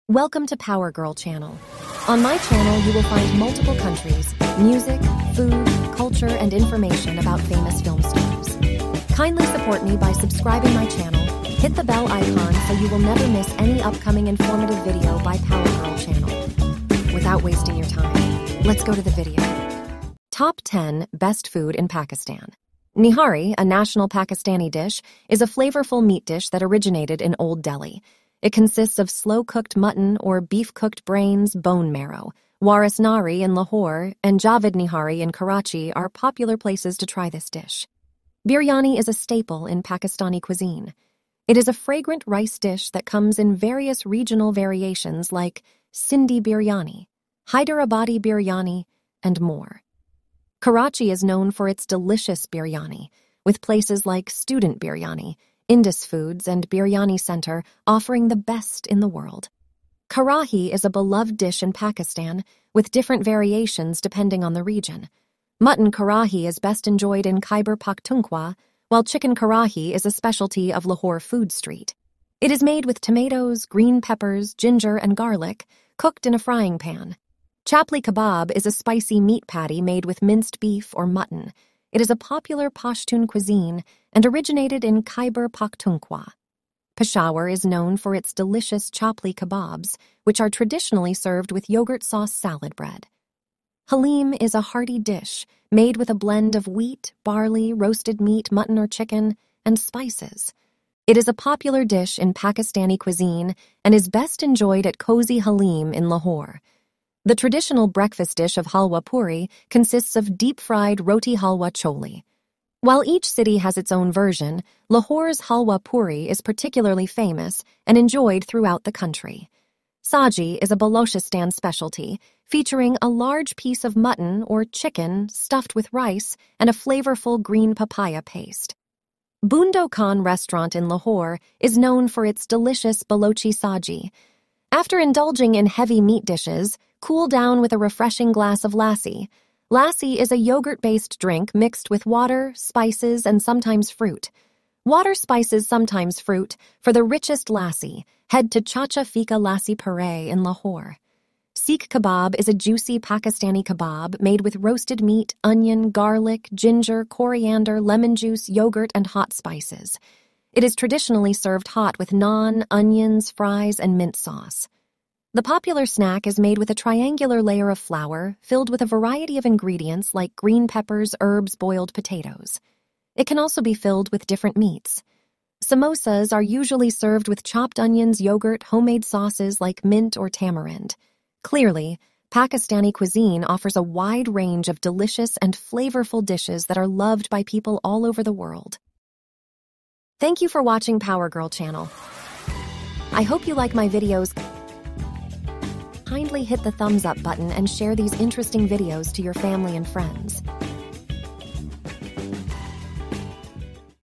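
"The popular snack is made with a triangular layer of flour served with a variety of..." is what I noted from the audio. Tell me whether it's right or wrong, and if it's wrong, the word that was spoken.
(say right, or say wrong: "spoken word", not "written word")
wrong: "filled", not "served".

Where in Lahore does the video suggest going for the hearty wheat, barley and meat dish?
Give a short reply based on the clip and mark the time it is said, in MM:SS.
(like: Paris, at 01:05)
Cozy Halim, at 01:44.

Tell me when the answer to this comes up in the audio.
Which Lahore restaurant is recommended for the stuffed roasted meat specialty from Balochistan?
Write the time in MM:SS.
02:09.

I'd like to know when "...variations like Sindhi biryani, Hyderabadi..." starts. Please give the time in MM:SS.
00:44.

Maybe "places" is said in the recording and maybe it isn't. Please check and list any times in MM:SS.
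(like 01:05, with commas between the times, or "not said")
00:36, 00:53.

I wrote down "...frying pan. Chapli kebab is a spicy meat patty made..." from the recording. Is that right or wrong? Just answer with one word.
right.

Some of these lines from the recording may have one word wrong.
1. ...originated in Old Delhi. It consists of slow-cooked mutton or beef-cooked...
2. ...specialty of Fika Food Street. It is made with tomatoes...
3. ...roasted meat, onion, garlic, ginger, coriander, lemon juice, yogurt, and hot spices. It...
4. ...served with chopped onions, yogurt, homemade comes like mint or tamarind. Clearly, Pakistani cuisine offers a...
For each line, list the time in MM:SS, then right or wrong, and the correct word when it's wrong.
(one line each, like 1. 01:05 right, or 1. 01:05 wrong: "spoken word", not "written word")
1. 00:26 right
2. 01:10 wrong: "Lahore", not "Fika"
3. 02:34 right
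4. 02:56 wrong: "sauces", not "comes".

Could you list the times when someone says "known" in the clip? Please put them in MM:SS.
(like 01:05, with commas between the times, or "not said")
00:51, 01:27, 02:11.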